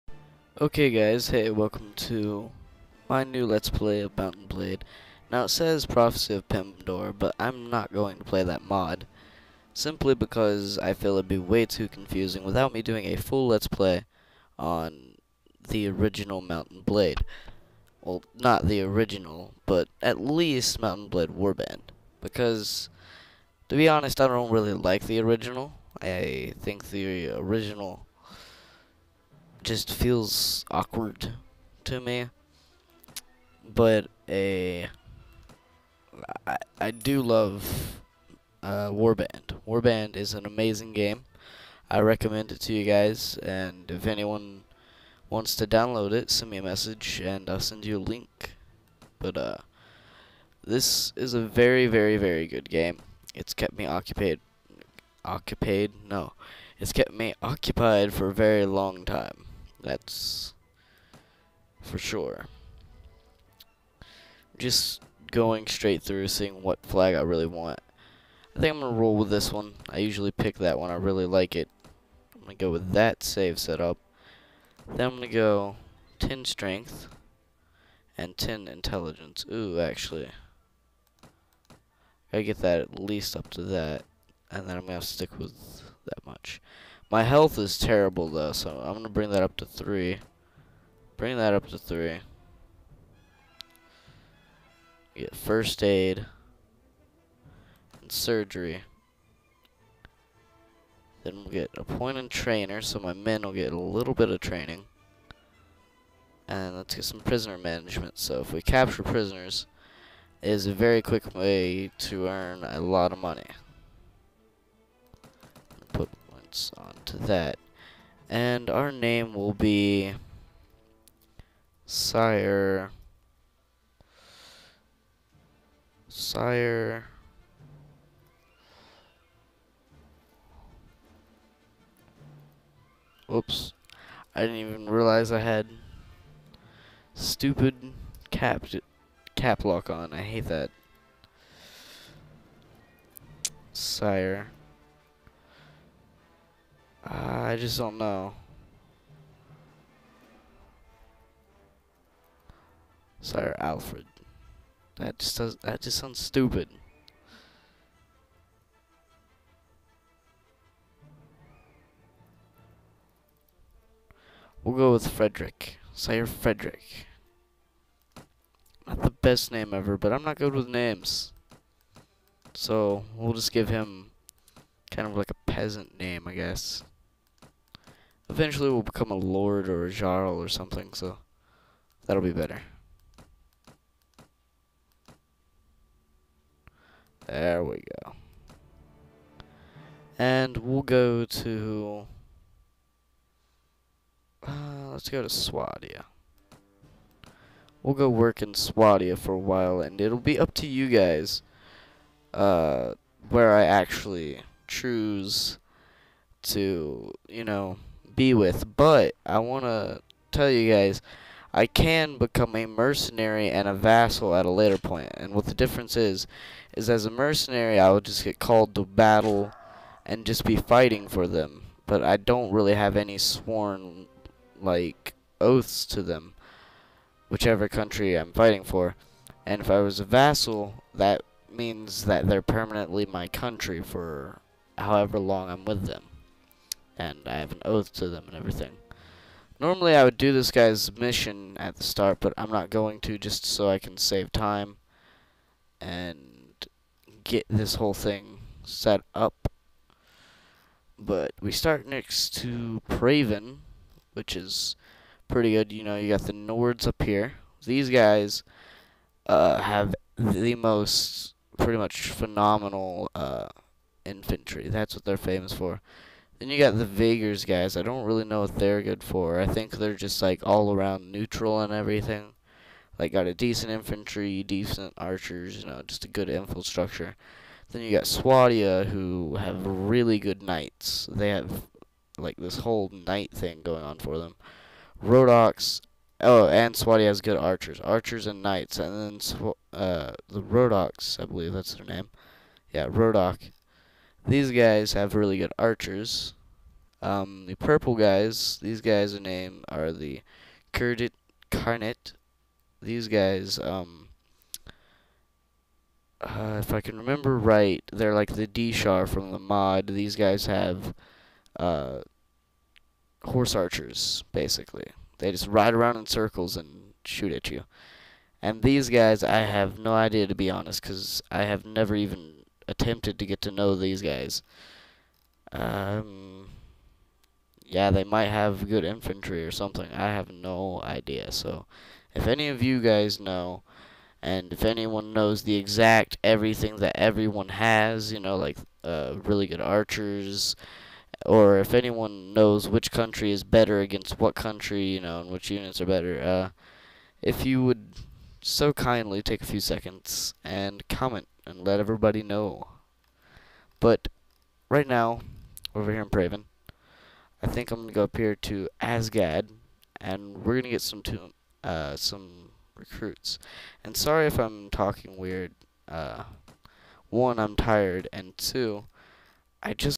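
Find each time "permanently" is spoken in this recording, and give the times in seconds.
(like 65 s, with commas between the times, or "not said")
232 s.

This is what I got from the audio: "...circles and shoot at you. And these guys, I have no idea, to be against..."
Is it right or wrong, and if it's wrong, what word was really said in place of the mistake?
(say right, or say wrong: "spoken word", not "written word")
wrong: "honest", not "against".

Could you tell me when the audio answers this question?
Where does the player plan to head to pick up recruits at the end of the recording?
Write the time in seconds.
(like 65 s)
358 s.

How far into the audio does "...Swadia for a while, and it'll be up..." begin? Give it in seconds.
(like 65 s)
198 s.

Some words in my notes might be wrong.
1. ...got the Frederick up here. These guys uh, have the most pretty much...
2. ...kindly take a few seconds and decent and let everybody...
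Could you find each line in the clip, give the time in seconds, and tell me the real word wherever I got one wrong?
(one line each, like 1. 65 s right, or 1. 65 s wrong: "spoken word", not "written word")
1. 256 s wrong: "Nords", not "Frederick"
2. 348 s wrong: "comment", not "decent".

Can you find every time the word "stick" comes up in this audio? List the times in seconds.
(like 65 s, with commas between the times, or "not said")
85 s.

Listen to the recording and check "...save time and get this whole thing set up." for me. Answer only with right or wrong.
right.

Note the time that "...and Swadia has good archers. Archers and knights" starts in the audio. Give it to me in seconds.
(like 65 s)
286 s.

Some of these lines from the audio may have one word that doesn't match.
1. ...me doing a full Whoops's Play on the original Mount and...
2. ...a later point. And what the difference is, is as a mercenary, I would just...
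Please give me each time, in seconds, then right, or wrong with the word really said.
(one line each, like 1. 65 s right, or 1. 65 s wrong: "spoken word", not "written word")
1. 12 s wrong: "Let", not "Whoops"
2. 214 s right.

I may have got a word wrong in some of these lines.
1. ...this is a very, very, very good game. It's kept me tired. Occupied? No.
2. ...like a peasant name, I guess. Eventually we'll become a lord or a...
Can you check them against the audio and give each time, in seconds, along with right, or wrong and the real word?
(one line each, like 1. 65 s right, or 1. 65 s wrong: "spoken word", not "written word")
1. 50 s wrong: "occupied", not "tired"
2. 175 s right.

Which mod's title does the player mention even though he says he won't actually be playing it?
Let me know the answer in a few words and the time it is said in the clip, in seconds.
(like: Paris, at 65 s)
Prophecy of Pendor, at 5 s.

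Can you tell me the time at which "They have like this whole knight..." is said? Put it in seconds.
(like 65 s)
281 s.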